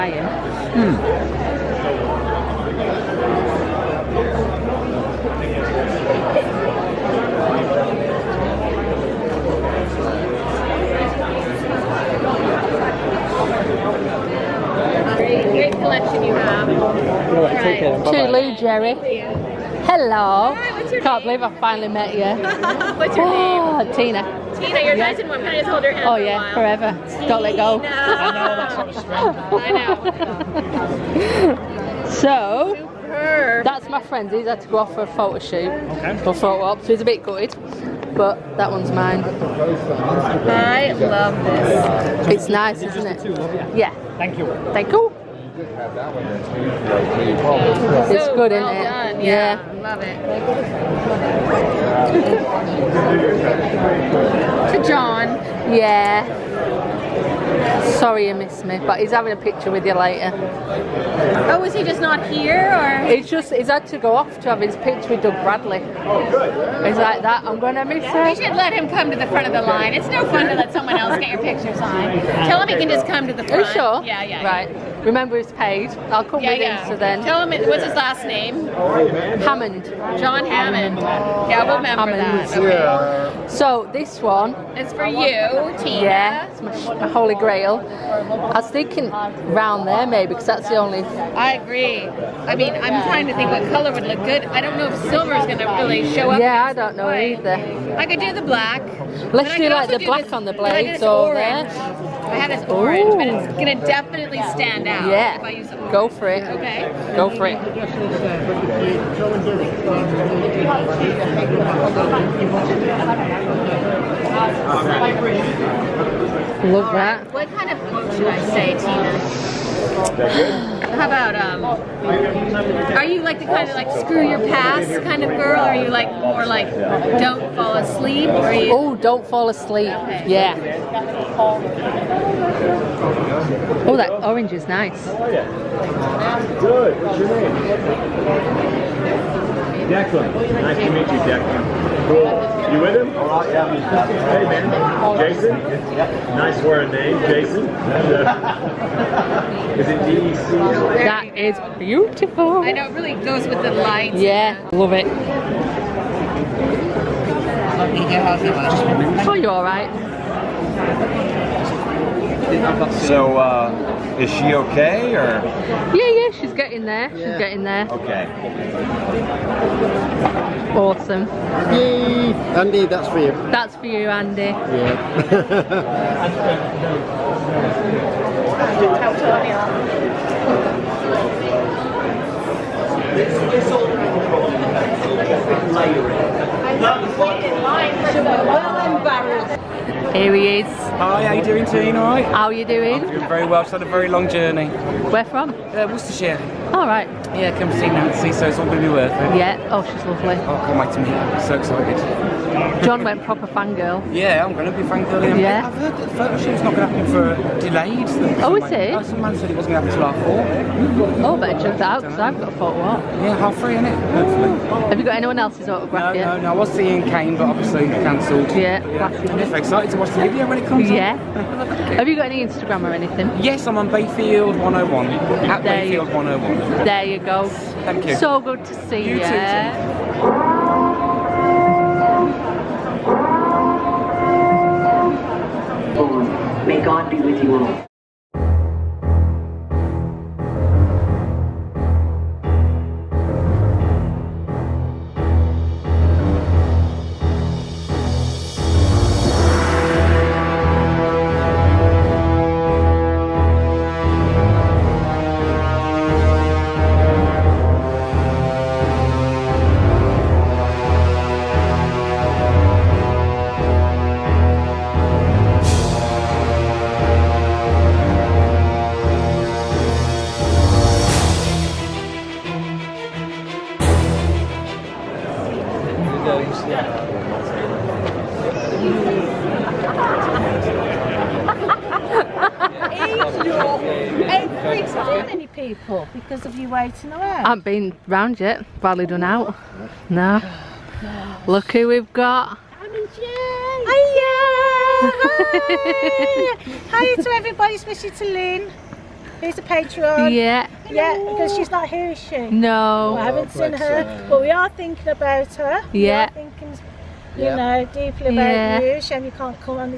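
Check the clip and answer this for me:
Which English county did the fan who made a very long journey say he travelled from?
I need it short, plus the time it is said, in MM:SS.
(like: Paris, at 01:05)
Worcestershire, at 03:15.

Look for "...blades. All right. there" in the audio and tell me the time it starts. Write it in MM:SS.
01:40.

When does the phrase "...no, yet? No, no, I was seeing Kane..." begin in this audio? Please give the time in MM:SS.
03:36.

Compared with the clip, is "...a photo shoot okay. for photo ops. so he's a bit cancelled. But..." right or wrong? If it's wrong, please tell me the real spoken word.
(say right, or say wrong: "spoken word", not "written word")
wrong: "gutted", not "cancelled".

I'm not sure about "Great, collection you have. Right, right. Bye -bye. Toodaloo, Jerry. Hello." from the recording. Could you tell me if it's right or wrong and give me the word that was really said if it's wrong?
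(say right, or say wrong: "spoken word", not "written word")
right.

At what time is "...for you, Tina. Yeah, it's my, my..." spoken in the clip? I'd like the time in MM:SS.
01:24.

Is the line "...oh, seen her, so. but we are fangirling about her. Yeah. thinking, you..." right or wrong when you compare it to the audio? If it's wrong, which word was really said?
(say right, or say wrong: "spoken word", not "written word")
wrong: "thinking", not "fangirling".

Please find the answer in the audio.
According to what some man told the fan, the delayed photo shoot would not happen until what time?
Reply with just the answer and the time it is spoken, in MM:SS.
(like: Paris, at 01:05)
half four, at 03:30.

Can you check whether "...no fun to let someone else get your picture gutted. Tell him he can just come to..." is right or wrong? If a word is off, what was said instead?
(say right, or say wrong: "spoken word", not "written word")
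wrong: "signed", not "gutted".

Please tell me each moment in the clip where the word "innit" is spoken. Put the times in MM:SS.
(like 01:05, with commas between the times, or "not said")
03:33.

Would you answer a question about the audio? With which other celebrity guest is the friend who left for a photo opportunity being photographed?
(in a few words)
Doug Bradley.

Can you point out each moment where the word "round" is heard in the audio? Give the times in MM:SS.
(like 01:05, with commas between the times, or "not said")
01:29, 04:48.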